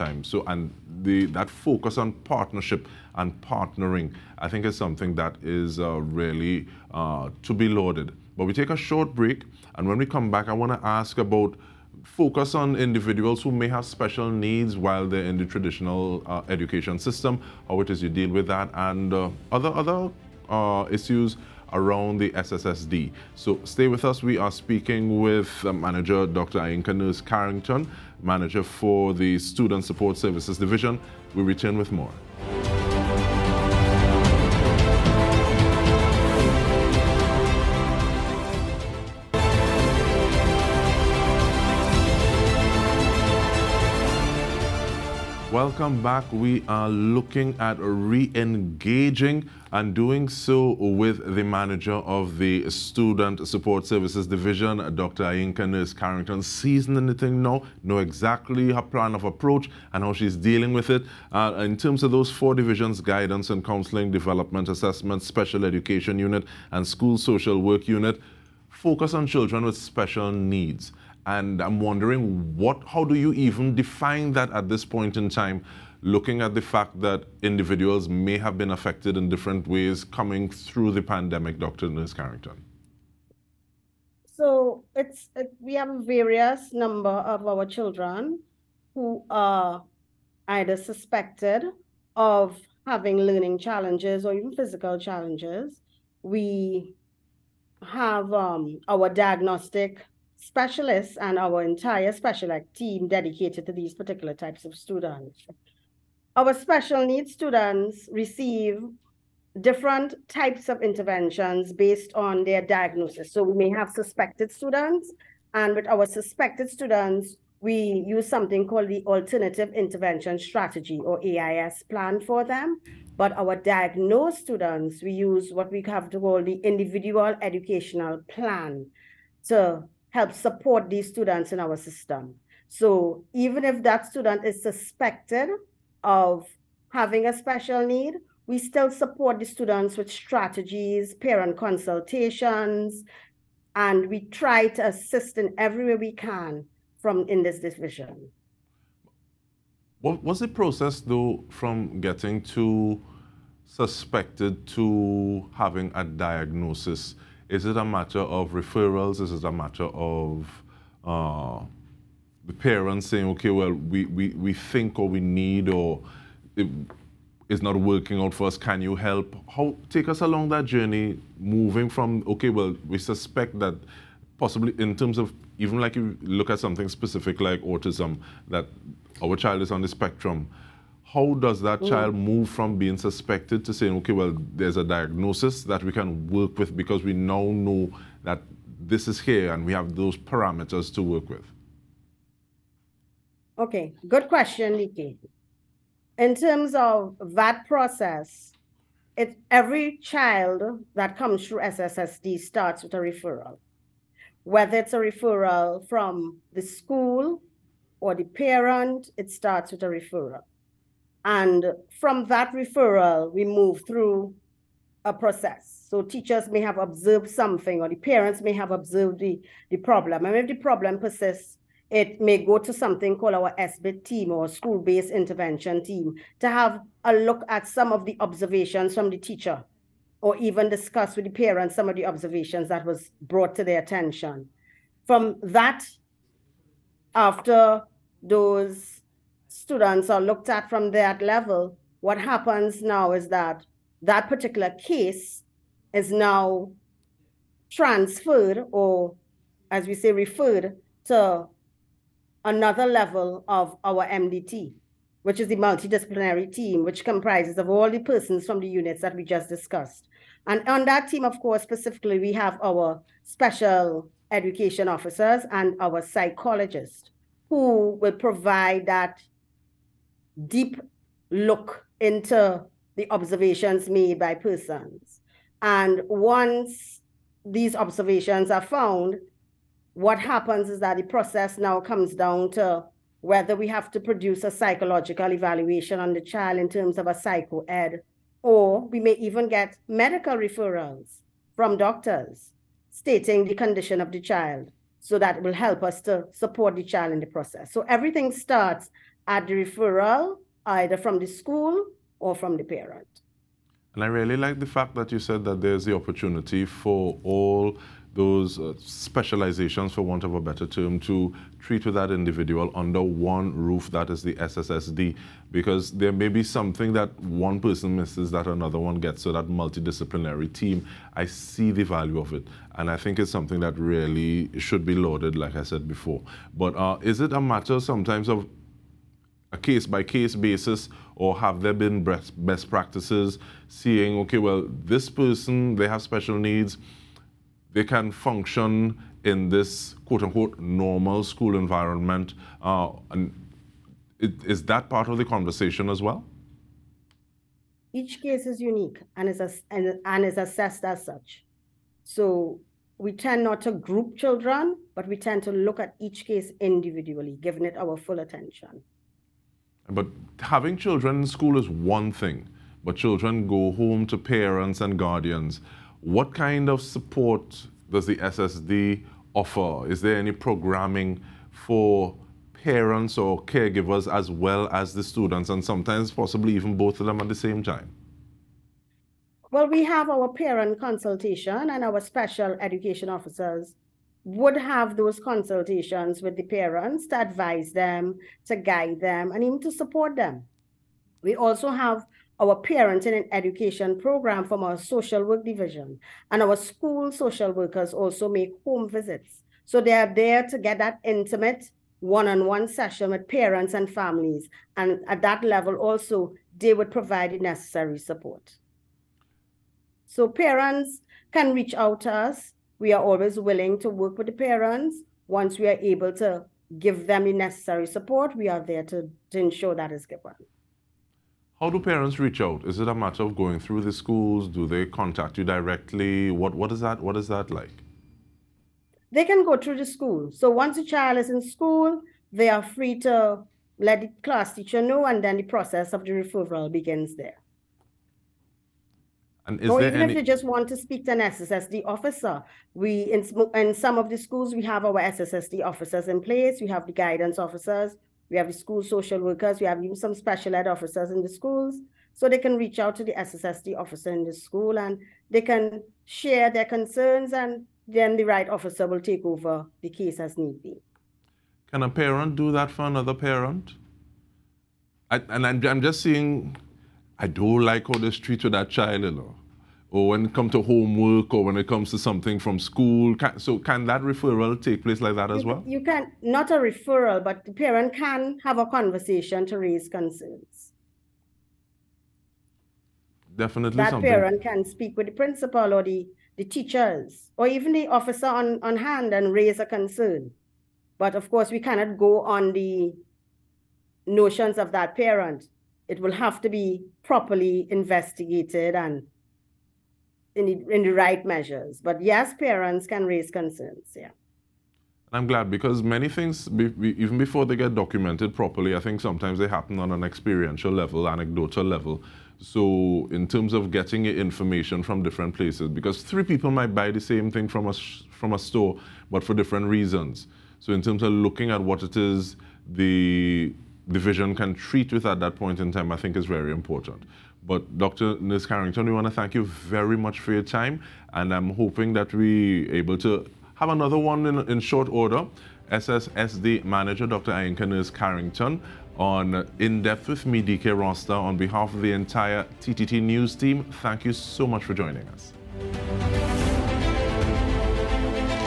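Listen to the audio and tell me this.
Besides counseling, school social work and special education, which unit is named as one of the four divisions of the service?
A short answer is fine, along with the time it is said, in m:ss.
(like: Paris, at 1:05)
development assessment, at 1:04.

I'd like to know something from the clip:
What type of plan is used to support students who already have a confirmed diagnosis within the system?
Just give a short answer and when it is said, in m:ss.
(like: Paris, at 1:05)
Individual Educational Plan, at 2:06.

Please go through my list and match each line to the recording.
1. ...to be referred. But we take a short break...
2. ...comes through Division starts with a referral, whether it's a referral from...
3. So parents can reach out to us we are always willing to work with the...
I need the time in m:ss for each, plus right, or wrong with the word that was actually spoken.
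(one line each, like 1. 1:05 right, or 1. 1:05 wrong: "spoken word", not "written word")
1. 0:07 wrong: "lauded", not "referred"
2. 3:21 wrong: "SSSD", not "Division"
3. 6:50 right.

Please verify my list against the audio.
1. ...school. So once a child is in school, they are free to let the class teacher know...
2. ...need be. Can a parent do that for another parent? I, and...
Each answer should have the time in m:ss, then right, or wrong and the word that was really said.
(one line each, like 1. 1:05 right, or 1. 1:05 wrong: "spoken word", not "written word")
1. 7:09 right
2. 7:40 right.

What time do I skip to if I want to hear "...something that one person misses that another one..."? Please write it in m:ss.
5:16.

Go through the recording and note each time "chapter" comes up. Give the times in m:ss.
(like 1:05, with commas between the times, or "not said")
not said.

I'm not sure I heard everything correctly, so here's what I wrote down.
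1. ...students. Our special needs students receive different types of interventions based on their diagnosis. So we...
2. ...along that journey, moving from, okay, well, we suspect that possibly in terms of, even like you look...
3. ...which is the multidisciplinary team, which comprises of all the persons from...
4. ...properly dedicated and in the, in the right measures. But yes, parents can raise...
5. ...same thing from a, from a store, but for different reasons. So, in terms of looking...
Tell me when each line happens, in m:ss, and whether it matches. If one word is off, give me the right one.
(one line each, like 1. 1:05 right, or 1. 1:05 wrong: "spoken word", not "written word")
1. 1:44 right
2. 2:50 right
3. 4:15 right
4. 8:17 wrong: "investigated", not "dedicated"
5. 8:37 right.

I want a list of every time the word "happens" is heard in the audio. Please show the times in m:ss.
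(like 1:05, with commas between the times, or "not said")
4:02, 4:40, 8:29.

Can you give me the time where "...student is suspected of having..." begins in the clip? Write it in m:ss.
2:14.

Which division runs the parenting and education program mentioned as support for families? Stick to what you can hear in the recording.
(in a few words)
social work division.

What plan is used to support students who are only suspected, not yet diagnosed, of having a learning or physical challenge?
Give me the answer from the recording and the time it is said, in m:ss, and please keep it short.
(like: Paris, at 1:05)
Alternative Intervention Strategy, at 1:59.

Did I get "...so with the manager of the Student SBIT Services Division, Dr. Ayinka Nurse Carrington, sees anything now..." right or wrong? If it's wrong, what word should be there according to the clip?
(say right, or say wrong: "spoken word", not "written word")
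wrong: "Support", not "SBIT".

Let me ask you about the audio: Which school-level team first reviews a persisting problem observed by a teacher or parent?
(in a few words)
school-based intervention team.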